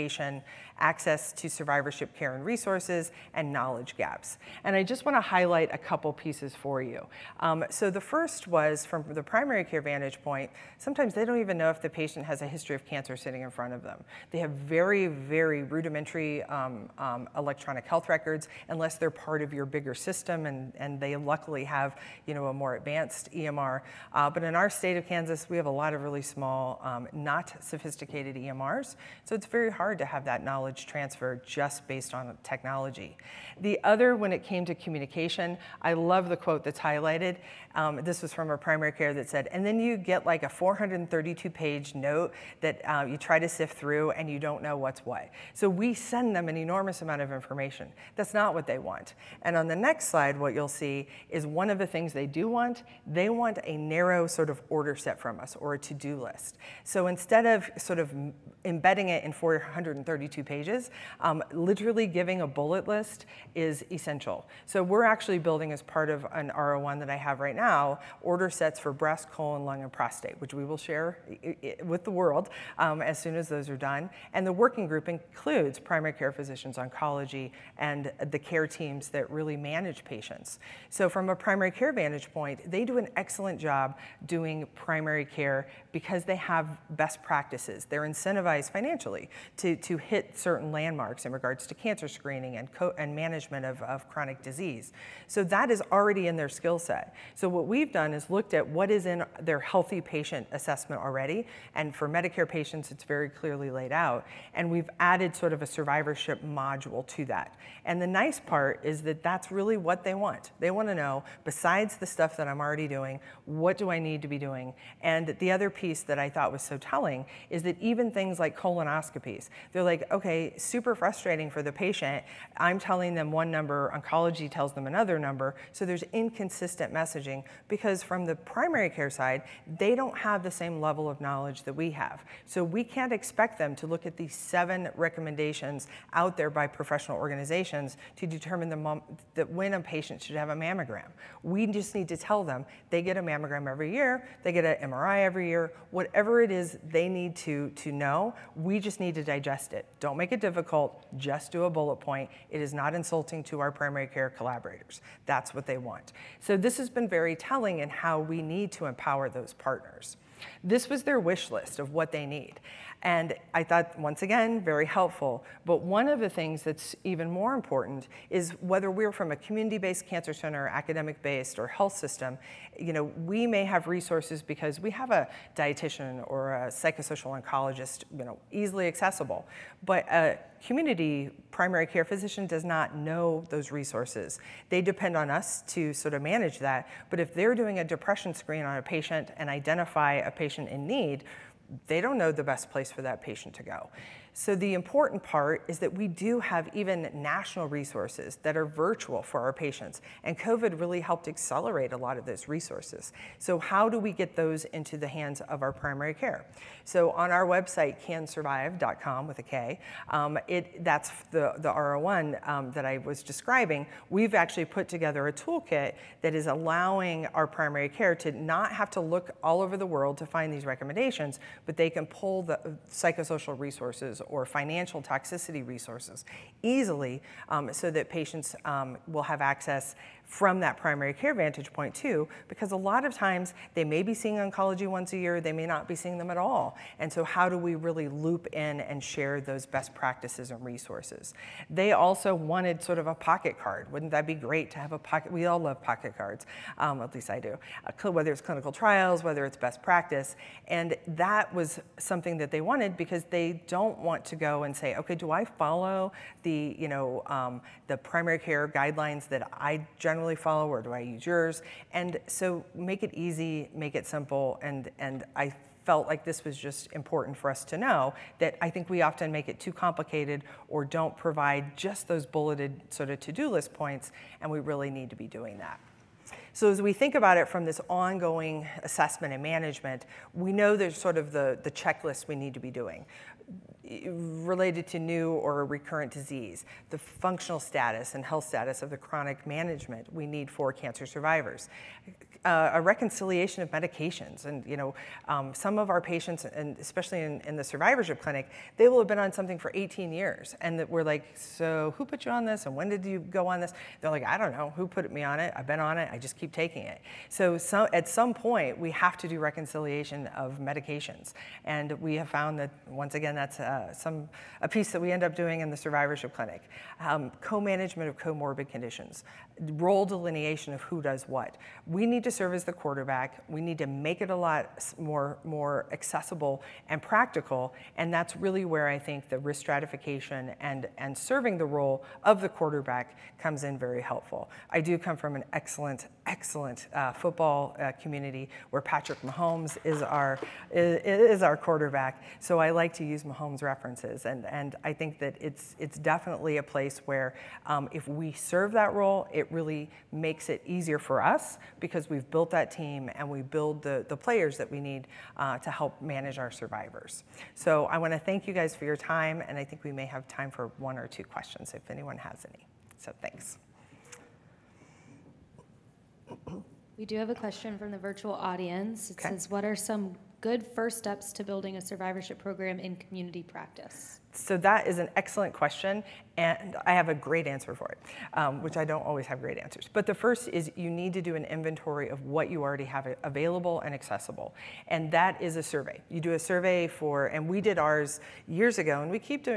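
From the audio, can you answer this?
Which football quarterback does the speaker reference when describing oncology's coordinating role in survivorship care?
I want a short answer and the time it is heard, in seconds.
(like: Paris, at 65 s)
Patrick Mahomes, at 338 s.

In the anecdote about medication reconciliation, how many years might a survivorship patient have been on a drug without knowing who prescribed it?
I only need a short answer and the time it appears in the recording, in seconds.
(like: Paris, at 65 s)
18, at 299 s.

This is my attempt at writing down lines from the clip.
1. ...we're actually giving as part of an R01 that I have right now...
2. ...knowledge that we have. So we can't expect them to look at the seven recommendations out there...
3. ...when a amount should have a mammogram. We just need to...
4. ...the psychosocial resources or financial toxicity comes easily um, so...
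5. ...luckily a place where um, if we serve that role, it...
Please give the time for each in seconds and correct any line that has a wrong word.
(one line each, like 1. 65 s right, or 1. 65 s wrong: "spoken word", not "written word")
1. 64 s wrong: "building", not "giving"
2. 131 s right
3. 139 s wrong: "patient", not "amount"
4. 222 s wrong: "resources", not "comes"
5. 345 s wrong: "definitely", not "luckily".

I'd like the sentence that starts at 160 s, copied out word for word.
This was their wish list of what they need.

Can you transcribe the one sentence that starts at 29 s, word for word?
So it's very hard to have that knowledge transfer just based on technology.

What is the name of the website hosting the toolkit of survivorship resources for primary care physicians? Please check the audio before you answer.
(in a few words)
kansurvive.com.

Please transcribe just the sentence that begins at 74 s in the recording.
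And the working group includes primary care physicians, oncology, and the care teams that really manage patients.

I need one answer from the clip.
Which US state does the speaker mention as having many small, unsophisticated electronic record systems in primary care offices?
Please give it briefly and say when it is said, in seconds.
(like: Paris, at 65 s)
Kansas, at 25 s.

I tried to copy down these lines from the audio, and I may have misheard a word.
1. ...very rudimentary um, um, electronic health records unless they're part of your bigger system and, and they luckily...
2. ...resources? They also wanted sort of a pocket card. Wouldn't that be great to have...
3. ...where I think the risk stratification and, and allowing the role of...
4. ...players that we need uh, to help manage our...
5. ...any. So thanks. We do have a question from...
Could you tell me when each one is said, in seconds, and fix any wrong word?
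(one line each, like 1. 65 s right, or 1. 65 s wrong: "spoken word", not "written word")
1. 15 s right
2. 240 s right
3. 328 s wrong: "serving", not "allowing"
4. 354 s right
5. 362 s right.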